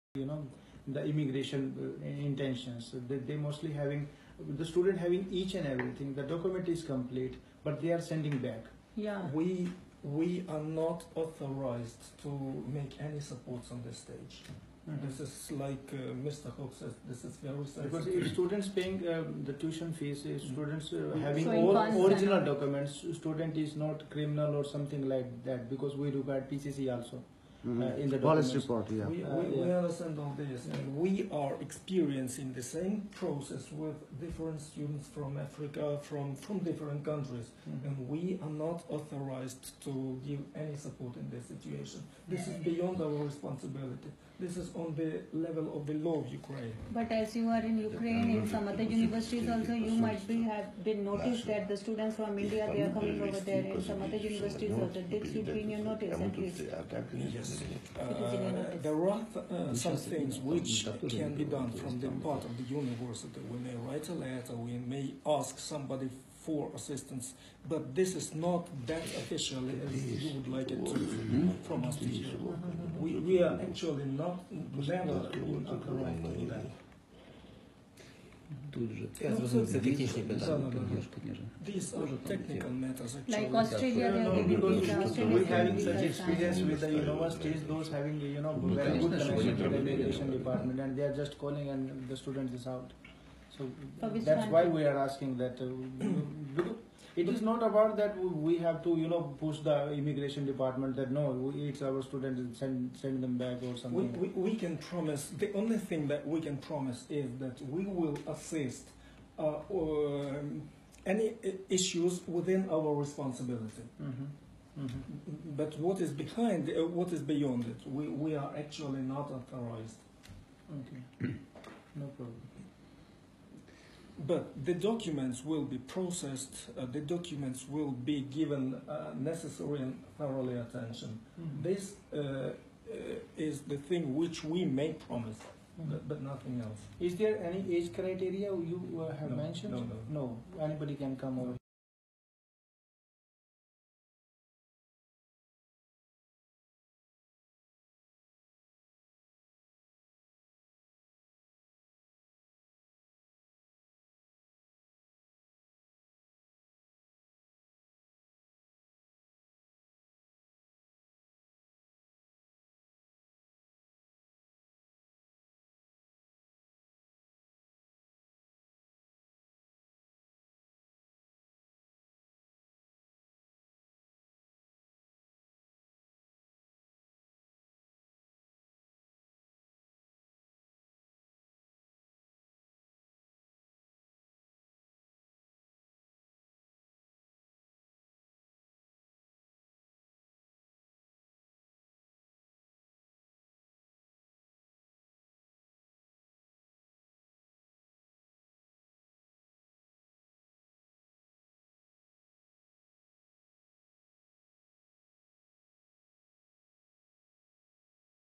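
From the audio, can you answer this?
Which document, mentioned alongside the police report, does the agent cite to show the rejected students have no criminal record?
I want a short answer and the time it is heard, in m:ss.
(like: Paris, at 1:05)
PCC, at 0:26.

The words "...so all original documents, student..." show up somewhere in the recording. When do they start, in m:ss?
0:21.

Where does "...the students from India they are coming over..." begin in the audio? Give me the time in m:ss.
0:51.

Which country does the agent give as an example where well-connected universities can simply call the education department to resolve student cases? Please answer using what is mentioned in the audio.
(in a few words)
Australia.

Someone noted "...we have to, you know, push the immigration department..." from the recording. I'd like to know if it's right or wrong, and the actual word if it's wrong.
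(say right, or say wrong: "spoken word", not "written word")
right.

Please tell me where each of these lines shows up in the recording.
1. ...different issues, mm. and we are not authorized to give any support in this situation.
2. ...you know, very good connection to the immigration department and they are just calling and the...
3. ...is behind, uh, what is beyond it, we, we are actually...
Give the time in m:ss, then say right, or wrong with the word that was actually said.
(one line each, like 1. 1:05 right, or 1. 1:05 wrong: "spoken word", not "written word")
1. 0:36 wrong: "countries", not "issues"
2. 1:28 wrong: "education", not "immigration"
3. 1:55 right.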